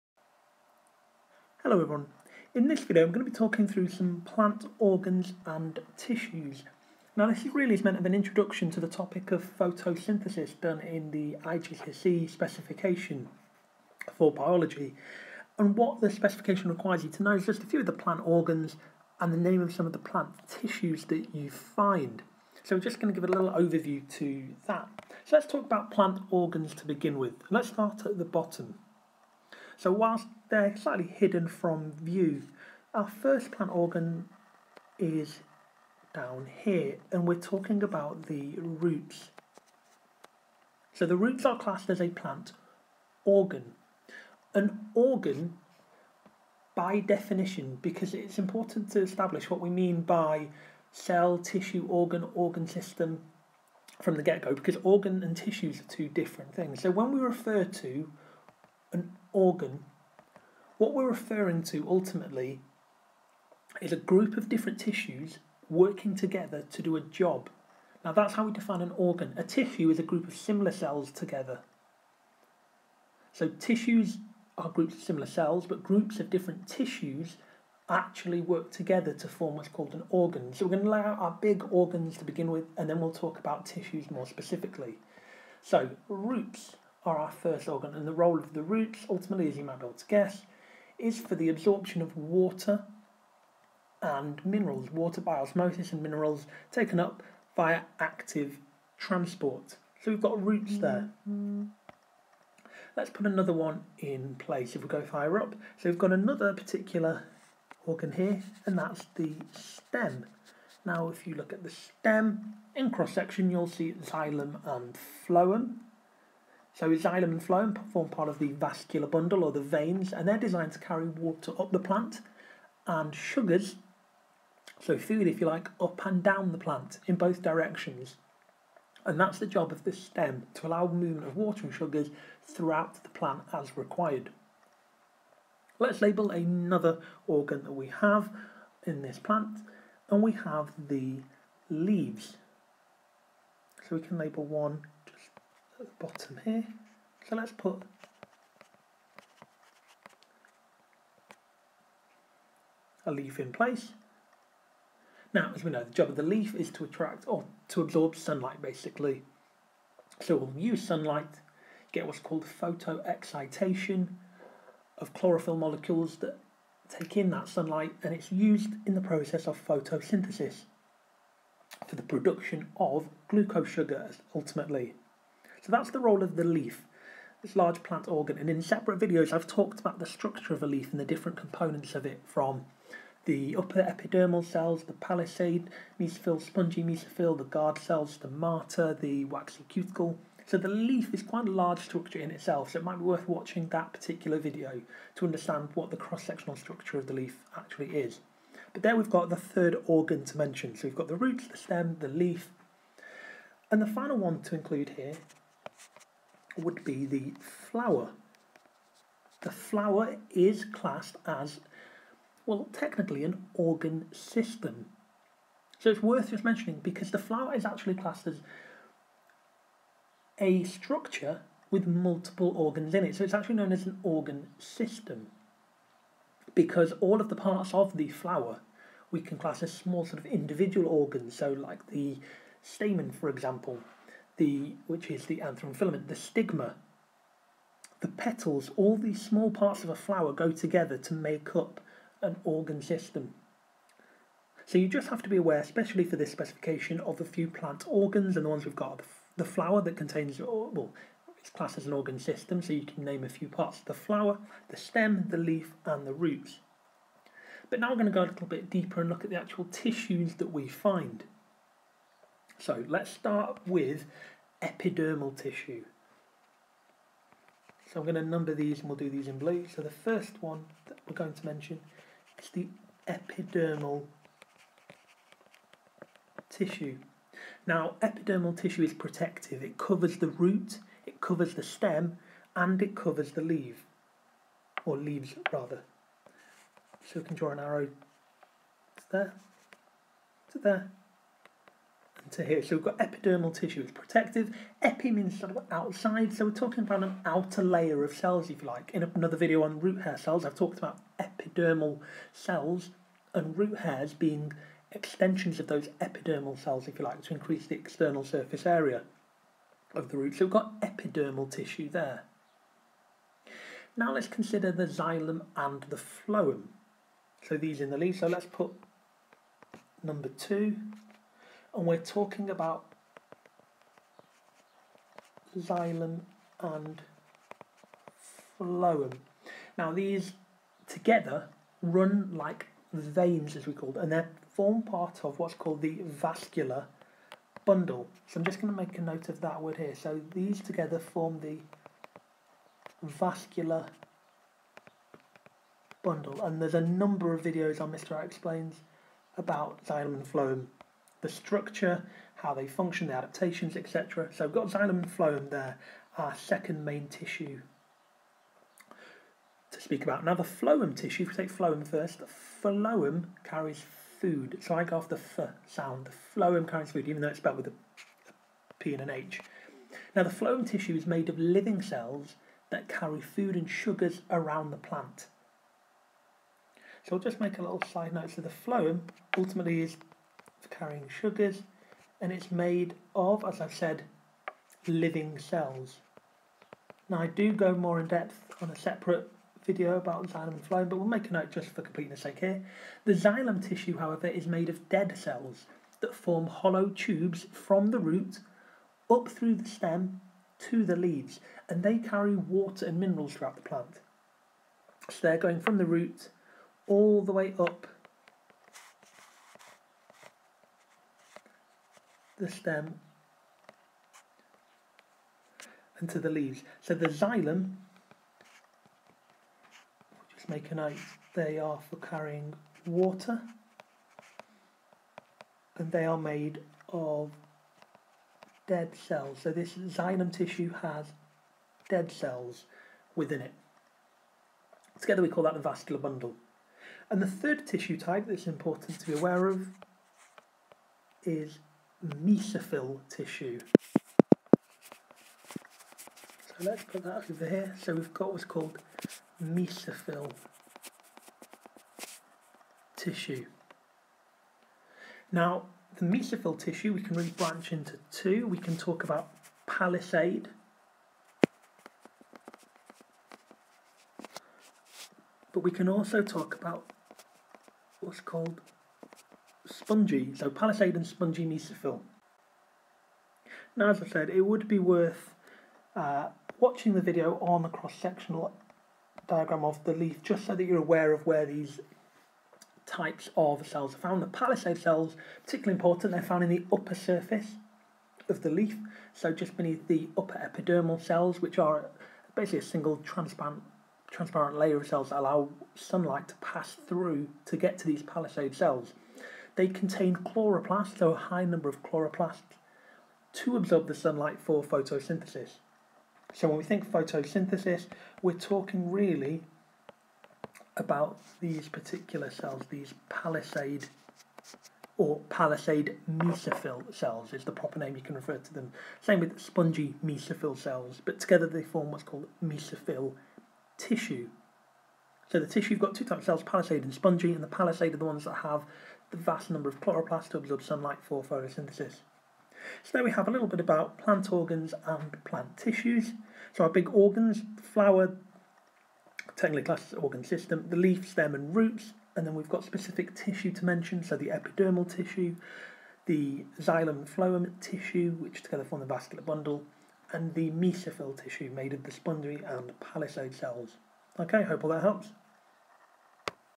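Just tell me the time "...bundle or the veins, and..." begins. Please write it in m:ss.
1:59.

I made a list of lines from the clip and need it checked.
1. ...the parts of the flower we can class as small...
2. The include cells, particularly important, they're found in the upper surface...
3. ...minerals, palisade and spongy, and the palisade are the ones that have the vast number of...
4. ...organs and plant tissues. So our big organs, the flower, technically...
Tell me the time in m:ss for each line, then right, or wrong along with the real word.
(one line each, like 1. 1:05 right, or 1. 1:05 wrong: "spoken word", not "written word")
1. 3:47 right
2. 8:04 wrong: "palisade", not "include"
3. 8:46 wrong: "cells", not "minerals"
4. 8:54 right.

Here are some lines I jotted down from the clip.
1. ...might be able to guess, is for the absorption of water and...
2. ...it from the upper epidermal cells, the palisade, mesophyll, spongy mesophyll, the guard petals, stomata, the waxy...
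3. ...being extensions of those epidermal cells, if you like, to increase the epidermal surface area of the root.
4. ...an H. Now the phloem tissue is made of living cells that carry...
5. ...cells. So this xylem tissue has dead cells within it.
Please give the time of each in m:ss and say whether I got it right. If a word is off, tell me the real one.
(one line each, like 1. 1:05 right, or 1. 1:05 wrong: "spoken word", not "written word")
1. 1:29 right
2. 3:02 wrong: "cells", not "petals"
3. 5:04 wrong: "external", not "epidermal"
4. 6:09 right
5. 7:09 right.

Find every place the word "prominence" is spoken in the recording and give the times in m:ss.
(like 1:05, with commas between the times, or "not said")
not said.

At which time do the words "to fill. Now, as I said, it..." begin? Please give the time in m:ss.
7:51.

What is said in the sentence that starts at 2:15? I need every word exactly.
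Let's label another organ that we have in this plant, and we have the leaves.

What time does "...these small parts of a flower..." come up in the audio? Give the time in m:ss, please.
3:58.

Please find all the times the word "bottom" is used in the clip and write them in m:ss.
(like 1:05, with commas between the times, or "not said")
0:28, 2:26.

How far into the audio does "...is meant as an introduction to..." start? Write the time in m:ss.
0:07.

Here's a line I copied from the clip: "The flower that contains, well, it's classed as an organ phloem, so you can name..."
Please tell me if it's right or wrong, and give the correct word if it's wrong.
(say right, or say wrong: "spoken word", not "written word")
wrong: "system", not "phloem".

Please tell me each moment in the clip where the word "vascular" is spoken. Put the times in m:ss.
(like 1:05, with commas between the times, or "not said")
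1:58, 5:36, 5:43, 7:15, 9:08.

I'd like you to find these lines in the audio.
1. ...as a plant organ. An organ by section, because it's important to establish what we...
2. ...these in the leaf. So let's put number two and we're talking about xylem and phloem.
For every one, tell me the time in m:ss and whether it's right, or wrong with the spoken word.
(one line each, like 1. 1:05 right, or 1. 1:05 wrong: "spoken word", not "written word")
1. 0:41 wrong: "definition", not "section"
2. 5:17 right.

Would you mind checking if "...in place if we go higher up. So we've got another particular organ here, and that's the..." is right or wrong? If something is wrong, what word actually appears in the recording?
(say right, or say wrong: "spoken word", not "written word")
right.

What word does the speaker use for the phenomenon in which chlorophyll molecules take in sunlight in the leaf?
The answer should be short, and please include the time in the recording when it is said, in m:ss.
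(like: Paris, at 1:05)
Photoexcitation, at 2:42.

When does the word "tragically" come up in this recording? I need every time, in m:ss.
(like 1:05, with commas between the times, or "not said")
not said.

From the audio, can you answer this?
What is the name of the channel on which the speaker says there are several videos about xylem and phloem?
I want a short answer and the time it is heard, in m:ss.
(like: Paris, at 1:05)
Mr. I Explains, at 5:47.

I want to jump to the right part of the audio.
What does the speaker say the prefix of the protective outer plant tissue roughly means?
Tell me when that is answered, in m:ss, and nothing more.
4:55.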